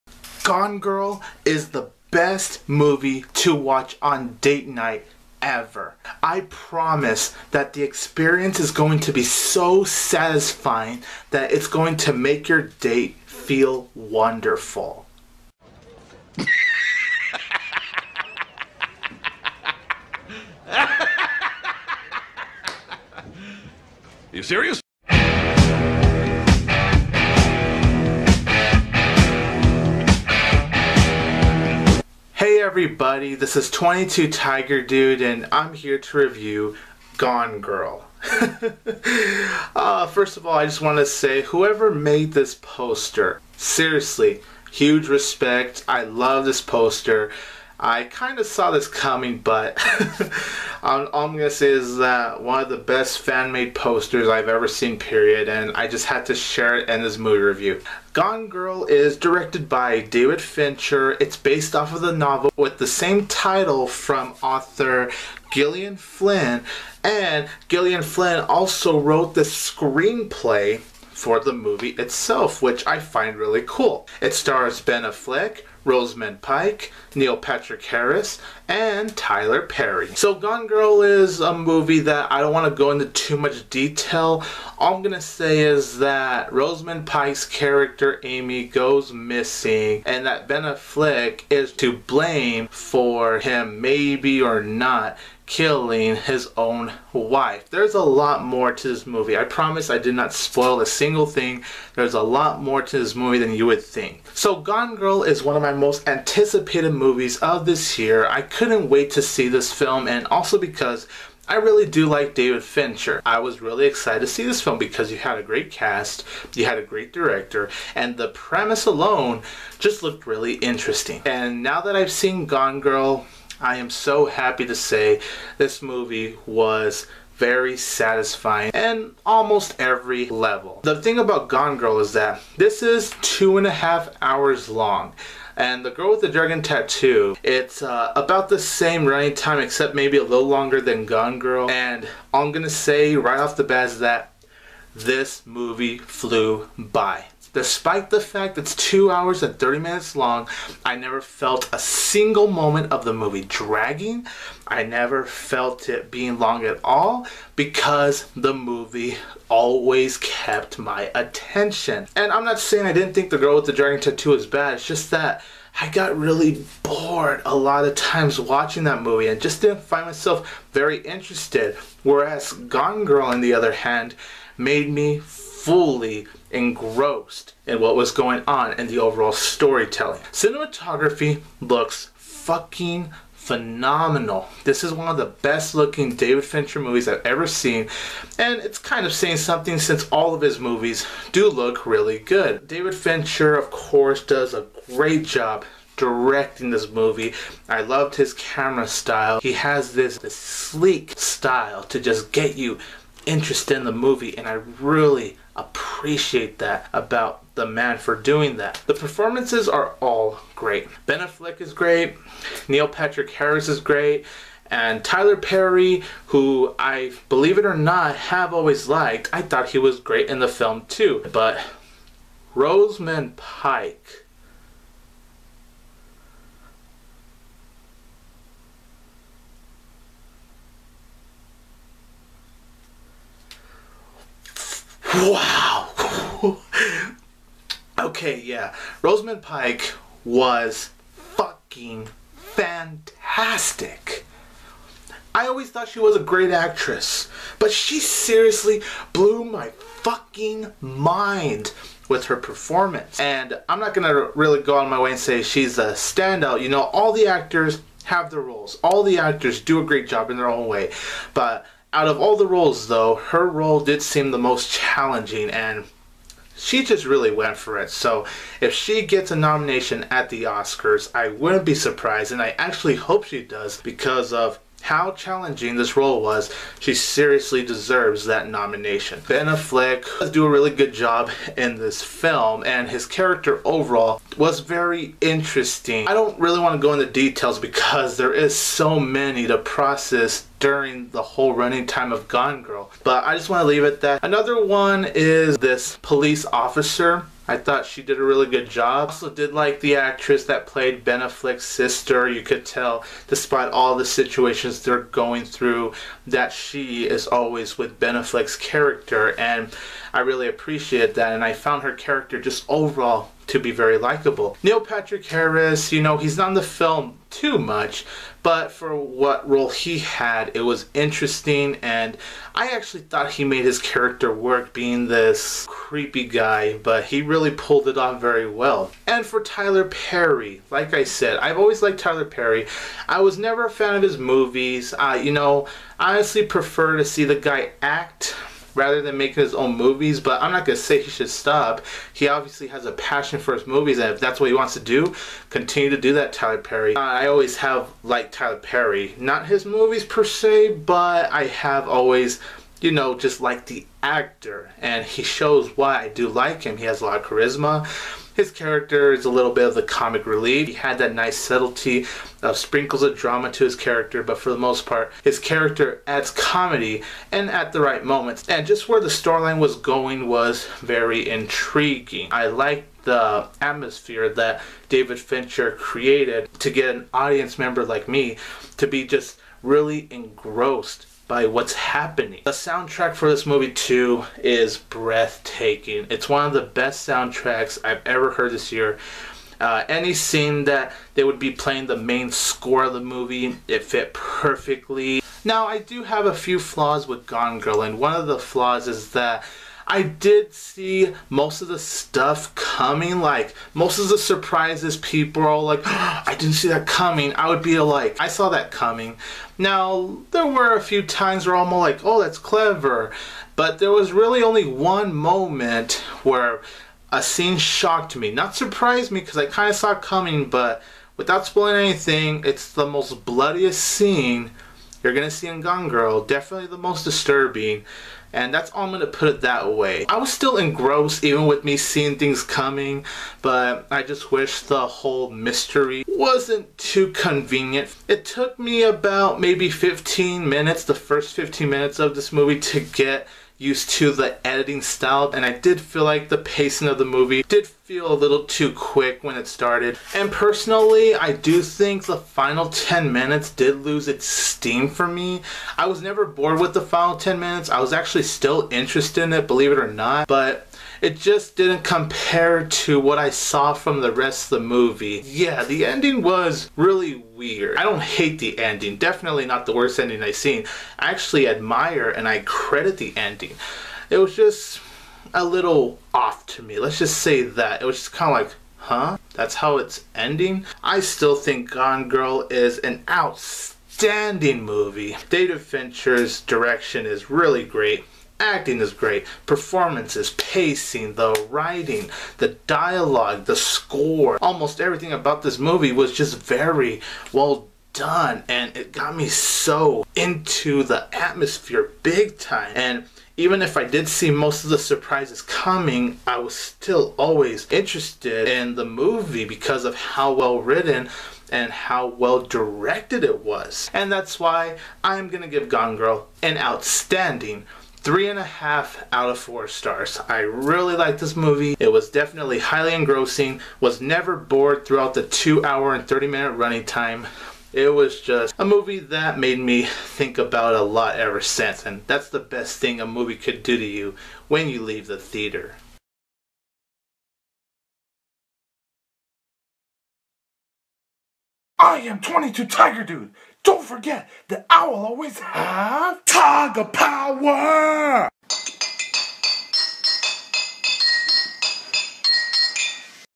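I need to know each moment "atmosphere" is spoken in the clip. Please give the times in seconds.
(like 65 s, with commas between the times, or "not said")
373 s, 501 s.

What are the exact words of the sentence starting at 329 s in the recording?
And for Tyler Perry, like I said, I've always liked Tyler Perry.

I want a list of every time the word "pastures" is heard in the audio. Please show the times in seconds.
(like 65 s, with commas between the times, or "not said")
not said.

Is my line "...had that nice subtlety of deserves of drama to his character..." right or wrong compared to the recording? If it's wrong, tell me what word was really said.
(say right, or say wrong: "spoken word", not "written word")
wrong: "sprinkles", not "deserves".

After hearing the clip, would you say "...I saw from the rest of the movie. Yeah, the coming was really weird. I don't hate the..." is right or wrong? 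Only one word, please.
wrong.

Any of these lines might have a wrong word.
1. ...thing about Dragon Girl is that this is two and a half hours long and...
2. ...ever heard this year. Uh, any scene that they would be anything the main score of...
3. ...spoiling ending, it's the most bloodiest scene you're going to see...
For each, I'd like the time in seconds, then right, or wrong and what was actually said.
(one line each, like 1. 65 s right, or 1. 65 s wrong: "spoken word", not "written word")
1. 131 s wrong: "Gone", not "Dragon"
2. 388 s wrong: "playing", not "anything"
3. 421 s wrong: "anything", not "ending".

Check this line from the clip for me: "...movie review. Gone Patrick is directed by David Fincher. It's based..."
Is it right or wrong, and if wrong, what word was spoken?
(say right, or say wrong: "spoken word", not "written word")
wrong: "Girl", not "Patrick".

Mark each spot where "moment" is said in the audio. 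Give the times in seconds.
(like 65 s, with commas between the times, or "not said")
152 s, 368 s, 415 s.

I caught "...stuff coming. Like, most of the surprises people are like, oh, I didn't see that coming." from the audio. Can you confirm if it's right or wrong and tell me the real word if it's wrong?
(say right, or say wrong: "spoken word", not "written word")
right.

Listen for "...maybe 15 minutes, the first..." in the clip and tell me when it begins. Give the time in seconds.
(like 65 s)
439 s.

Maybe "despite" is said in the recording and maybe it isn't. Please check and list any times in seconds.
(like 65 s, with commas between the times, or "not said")
147 s, 303 s.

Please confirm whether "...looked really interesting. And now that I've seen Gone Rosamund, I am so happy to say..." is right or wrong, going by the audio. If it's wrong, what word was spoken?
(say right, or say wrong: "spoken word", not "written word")
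wrong: "Girl", not "Rosamund".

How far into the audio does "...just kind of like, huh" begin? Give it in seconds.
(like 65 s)
477 s.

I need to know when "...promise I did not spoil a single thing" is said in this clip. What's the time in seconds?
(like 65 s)
99 s.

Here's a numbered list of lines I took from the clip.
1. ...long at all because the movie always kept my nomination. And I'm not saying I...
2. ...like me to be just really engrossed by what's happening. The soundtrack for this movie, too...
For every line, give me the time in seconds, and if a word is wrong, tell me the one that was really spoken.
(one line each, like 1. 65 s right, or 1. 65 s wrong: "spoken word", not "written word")
1. 156 s wrong: "attention", not "nomination"
2. 377 s right.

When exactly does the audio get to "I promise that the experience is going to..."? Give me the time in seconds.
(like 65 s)
6 s.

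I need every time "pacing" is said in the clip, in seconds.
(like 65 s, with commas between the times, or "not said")
446 s, 490 s.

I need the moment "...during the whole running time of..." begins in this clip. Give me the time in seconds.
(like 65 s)
290 s.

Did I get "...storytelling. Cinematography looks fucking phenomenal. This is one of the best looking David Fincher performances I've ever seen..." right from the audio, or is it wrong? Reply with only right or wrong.
wrong.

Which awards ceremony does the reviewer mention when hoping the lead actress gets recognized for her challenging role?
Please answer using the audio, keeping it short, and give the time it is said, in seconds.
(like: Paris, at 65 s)
The Oscars, at 270 s.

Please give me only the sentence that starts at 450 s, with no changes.
And personally, I do think the final 10 minutes did lose its steam for me.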